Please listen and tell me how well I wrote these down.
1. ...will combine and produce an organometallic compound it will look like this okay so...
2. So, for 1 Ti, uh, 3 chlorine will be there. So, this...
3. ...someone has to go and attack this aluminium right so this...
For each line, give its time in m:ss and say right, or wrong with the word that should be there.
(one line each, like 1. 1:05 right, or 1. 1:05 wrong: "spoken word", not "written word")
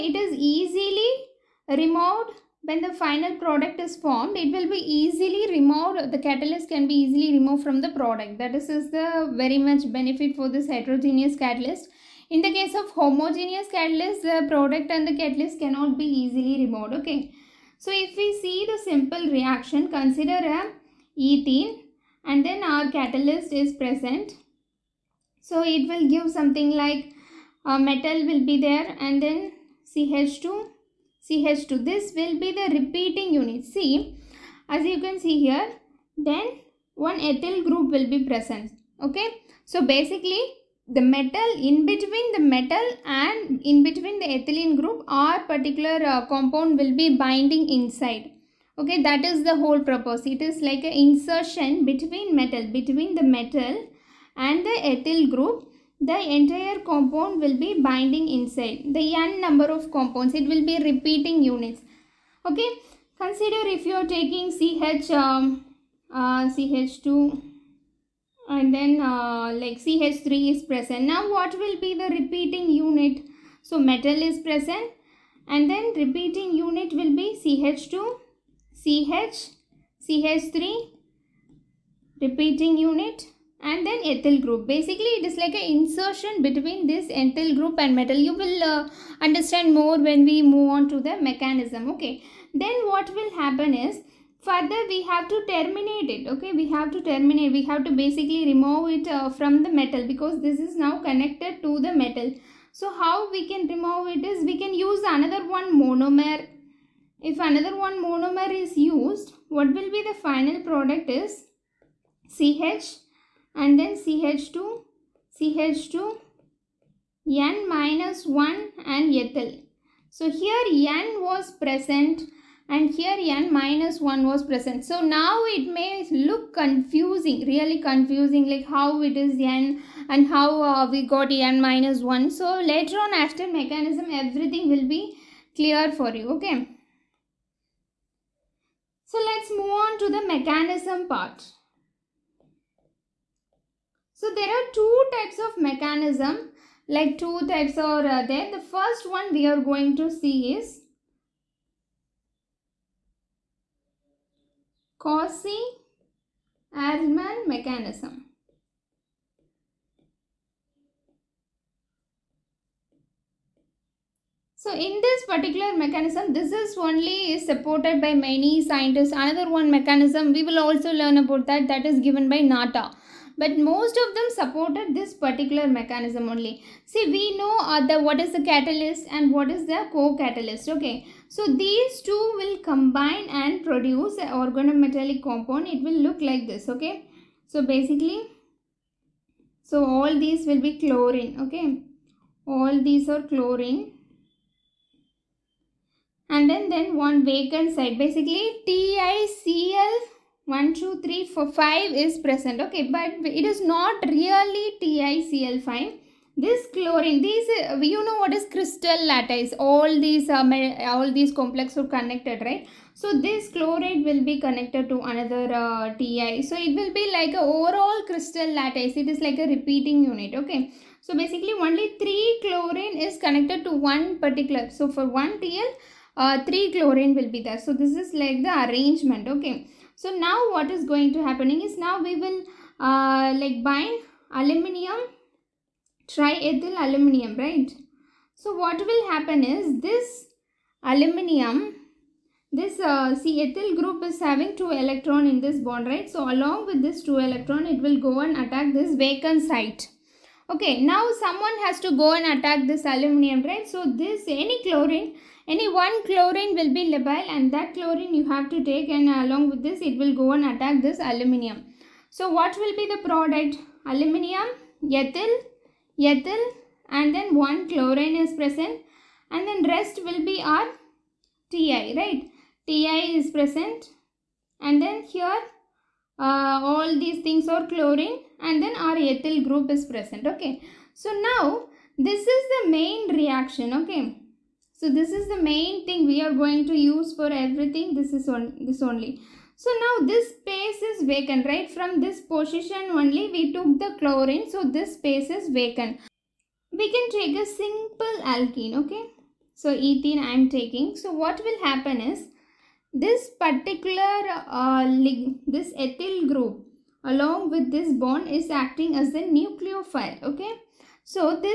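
1. 3:02 right
2. 3:44 right
3. 4:11 right.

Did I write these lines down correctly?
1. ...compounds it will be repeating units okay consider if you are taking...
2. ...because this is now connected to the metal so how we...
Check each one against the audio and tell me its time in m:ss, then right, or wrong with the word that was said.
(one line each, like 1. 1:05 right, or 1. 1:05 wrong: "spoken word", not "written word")
1. 0:59 right
2. 1:40 right.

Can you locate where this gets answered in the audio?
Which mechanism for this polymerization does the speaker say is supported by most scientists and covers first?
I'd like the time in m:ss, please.
2:34.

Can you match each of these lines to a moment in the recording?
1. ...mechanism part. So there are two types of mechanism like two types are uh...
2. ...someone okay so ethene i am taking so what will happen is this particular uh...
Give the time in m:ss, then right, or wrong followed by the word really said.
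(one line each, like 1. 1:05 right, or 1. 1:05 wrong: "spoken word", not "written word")
1. 2:20 right
2. 4:58 wrong: "alkene", not "someone".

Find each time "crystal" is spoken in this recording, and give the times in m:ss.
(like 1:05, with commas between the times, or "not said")
3:28, 3:38.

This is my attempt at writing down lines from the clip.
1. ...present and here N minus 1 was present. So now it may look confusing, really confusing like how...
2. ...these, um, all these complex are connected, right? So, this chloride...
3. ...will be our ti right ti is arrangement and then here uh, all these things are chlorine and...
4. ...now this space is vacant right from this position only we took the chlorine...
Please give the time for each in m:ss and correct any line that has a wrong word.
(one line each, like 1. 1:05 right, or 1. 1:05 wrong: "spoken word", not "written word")
1. 2:01 right
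2. 3:30 right
3. 4:30 wrong: "present", not "arrangement"
4. 4:49 right.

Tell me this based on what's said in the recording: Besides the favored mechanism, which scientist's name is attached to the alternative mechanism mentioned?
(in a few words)
Natta.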